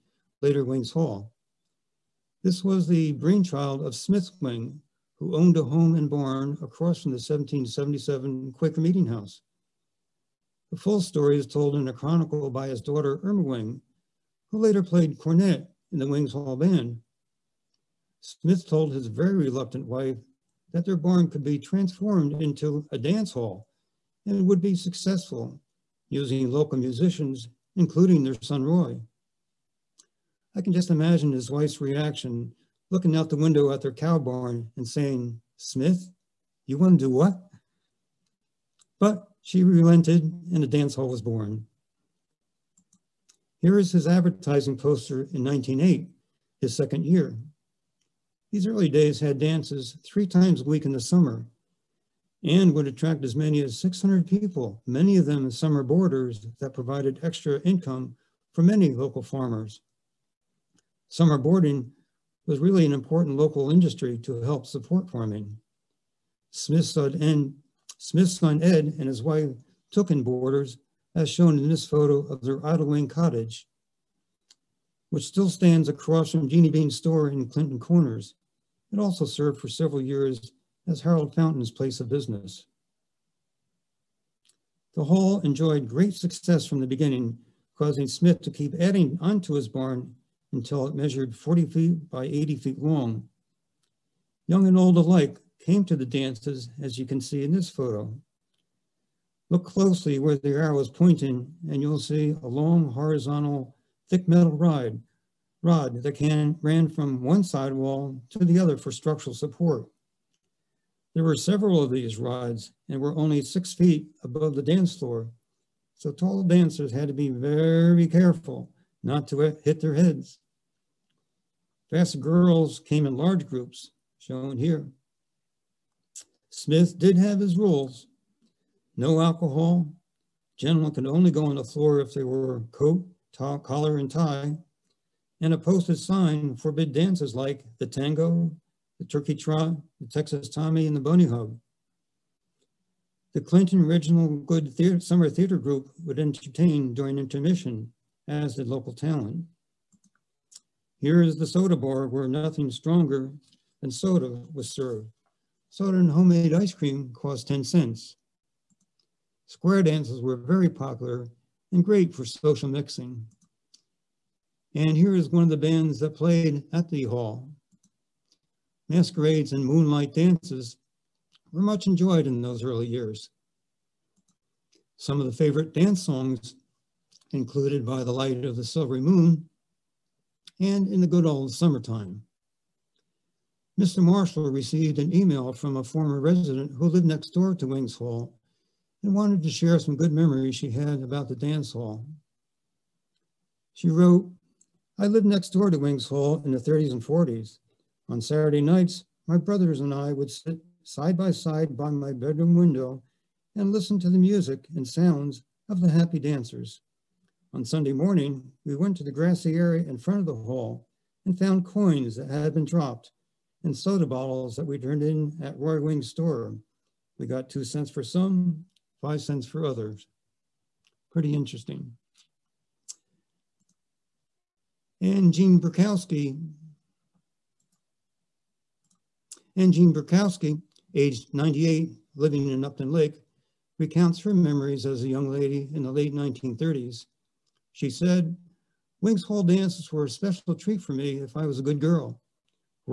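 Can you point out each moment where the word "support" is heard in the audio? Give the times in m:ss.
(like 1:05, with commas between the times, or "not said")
1:04, 1:49.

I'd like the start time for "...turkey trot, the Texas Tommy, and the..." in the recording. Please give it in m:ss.
2:19.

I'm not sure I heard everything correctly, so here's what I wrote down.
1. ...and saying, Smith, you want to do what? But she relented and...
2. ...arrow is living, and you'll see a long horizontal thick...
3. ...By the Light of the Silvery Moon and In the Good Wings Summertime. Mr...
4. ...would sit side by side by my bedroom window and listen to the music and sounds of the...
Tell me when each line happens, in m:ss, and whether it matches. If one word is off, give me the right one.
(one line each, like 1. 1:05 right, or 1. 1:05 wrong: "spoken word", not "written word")
1. 0:34 right
2. 1:40 wrong: "pointing", not "living"
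3. 2:57 wrong: "Old", not "Wings"
4. 3:20 right.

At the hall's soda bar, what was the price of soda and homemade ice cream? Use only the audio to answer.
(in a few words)
10 cents.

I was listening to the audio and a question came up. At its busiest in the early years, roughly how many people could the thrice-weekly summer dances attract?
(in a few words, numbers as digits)
600.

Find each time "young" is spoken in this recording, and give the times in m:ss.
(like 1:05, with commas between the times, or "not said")
1:34, 3:55.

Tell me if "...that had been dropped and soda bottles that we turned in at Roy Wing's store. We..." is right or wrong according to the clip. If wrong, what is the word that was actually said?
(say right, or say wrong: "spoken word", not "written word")
right.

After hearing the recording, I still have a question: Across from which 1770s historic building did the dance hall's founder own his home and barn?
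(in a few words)
1777 Quaker Meeting House.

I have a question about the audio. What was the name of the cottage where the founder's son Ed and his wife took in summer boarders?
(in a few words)
Idlewing.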